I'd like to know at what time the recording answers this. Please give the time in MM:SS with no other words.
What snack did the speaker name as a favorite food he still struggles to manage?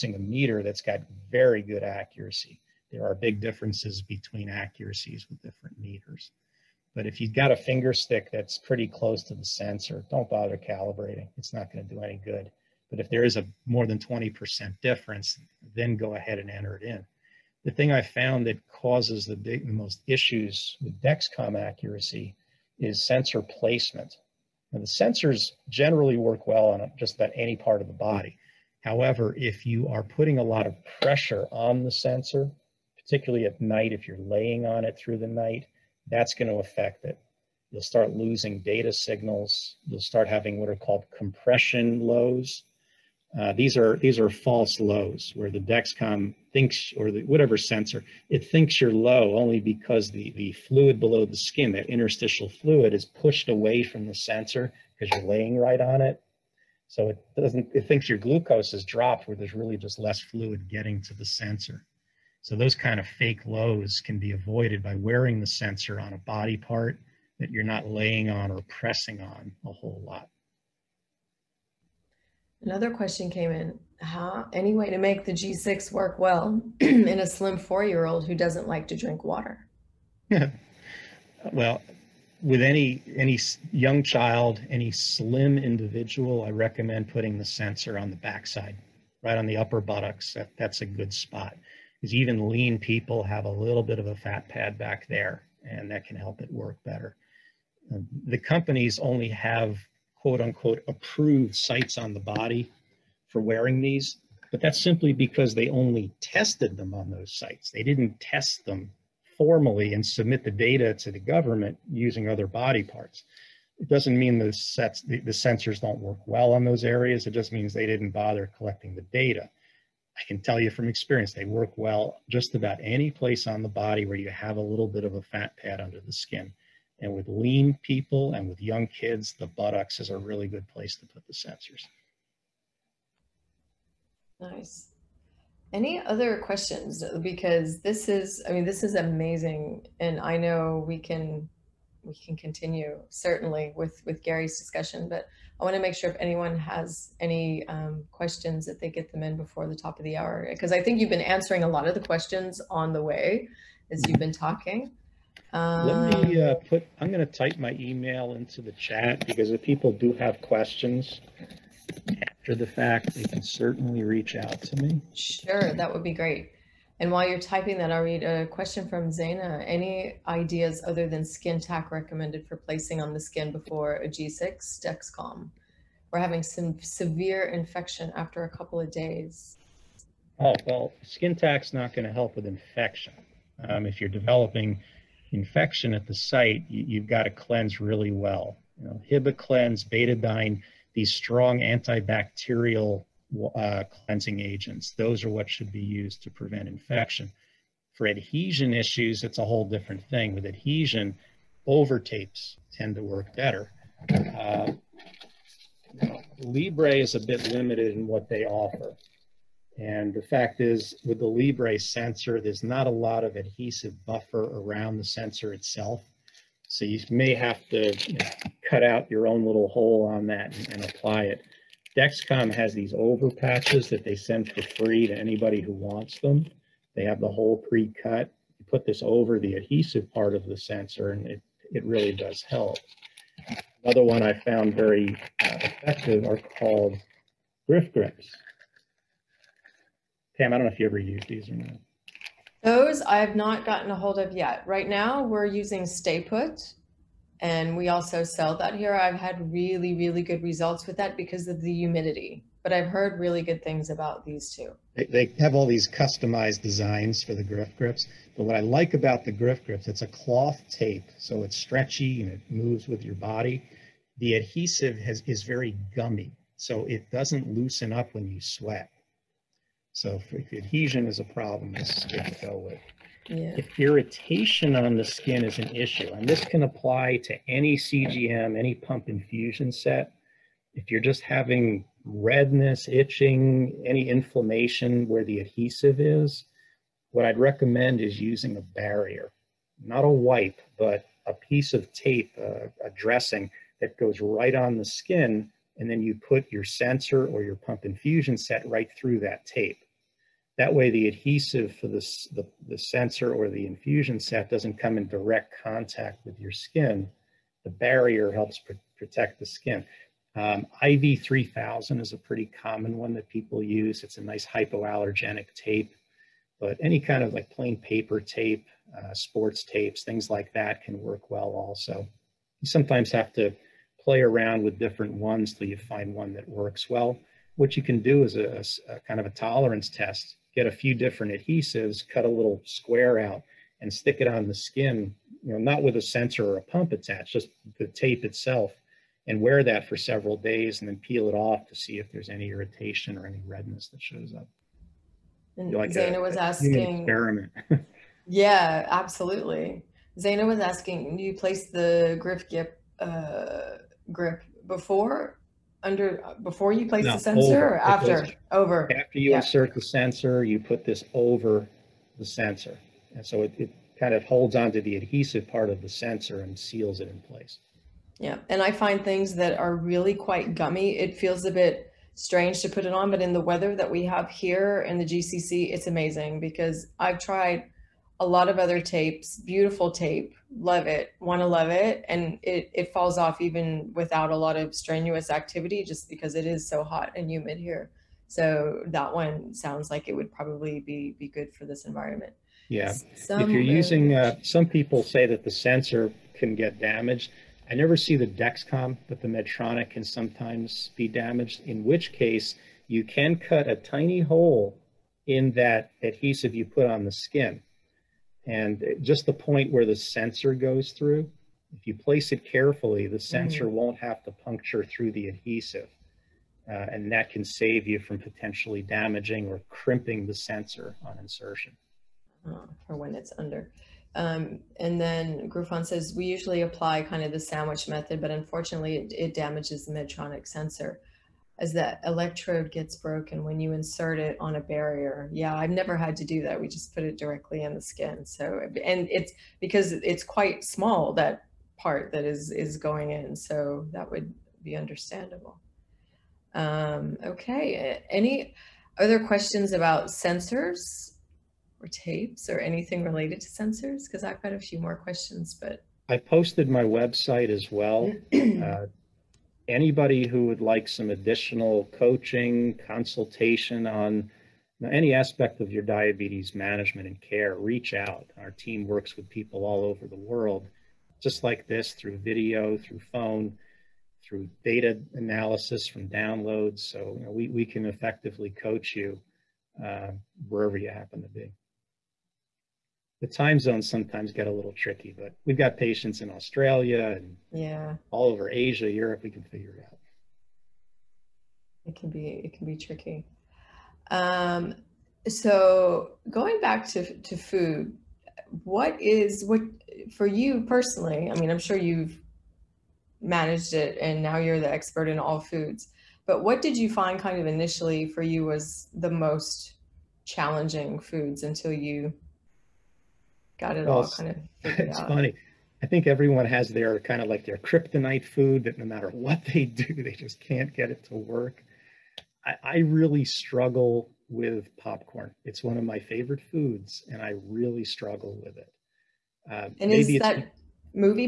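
08:44.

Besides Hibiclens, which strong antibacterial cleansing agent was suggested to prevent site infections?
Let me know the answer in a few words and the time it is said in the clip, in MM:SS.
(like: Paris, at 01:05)
betadine, at 03:09.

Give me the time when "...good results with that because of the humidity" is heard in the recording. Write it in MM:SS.
04:10.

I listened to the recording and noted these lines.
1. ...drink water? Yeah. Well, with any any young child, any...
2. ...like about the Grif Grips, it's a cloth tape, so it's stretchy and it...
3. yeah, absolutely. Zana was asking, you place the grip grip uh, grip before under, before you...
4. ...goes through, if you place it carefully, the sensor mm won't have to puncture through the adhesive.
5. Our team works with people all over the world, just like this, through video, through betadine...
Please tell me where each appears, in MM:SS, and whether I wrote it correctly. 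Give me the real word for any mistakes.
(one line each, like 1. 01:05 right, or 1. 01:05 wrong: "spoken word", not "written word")
1. 01:18 right
2. 04:18 right
3. 05:48 right
4. 06:50 right
5. 07:48 wrong: "phone", not "betadine".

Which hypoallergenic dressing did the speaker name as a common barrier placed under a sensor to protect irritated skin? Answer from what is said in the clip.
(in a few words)
IV3000.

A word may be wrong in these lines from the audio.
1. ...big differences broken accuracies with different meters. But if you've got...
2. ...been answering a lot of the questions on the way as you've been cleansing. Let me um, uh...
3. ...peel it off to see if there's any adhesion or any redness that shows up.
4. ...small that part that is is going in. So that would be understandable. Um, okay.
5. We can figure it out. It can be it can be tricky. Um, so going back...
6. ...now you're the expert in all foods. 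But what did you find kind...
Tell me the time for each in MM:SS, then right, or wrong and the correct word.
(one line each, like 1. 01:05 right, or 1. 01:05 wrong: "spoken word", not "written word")
1. 00:03 wrong: "between", not "broken"
2. 02:31 wrong: "talking", not "cleansing"
3. 05:40 wrong: "irritation", not "adhesion"
4. 07:20 right
5. 08:09 right
6. 08:24 right.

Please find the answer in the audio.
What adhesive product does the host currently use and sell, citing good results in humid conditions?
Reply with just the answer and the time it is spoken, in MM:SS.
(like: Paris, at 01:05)
Stay Put, at 04:05.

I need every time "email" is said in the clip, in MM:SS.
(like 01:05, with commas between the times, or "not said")
02:37.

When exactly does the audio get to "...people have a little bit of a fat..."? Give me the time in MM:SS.
01:32.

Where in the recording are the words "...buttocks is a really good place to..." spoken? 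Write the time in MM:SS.
02:09.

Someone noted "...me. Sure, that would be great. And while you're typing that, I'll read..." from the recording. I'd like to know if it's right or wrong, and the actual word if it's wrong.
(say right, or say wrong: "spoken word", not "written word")
right.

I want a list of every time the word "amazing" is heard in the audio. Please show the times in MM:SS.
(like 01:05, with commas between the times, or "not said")
02:18, 06:15.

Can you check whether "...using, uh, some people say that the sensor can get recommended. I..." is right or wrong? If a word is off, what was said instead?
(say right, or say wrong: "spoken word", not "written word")
wrong: "damaged", not "recommended".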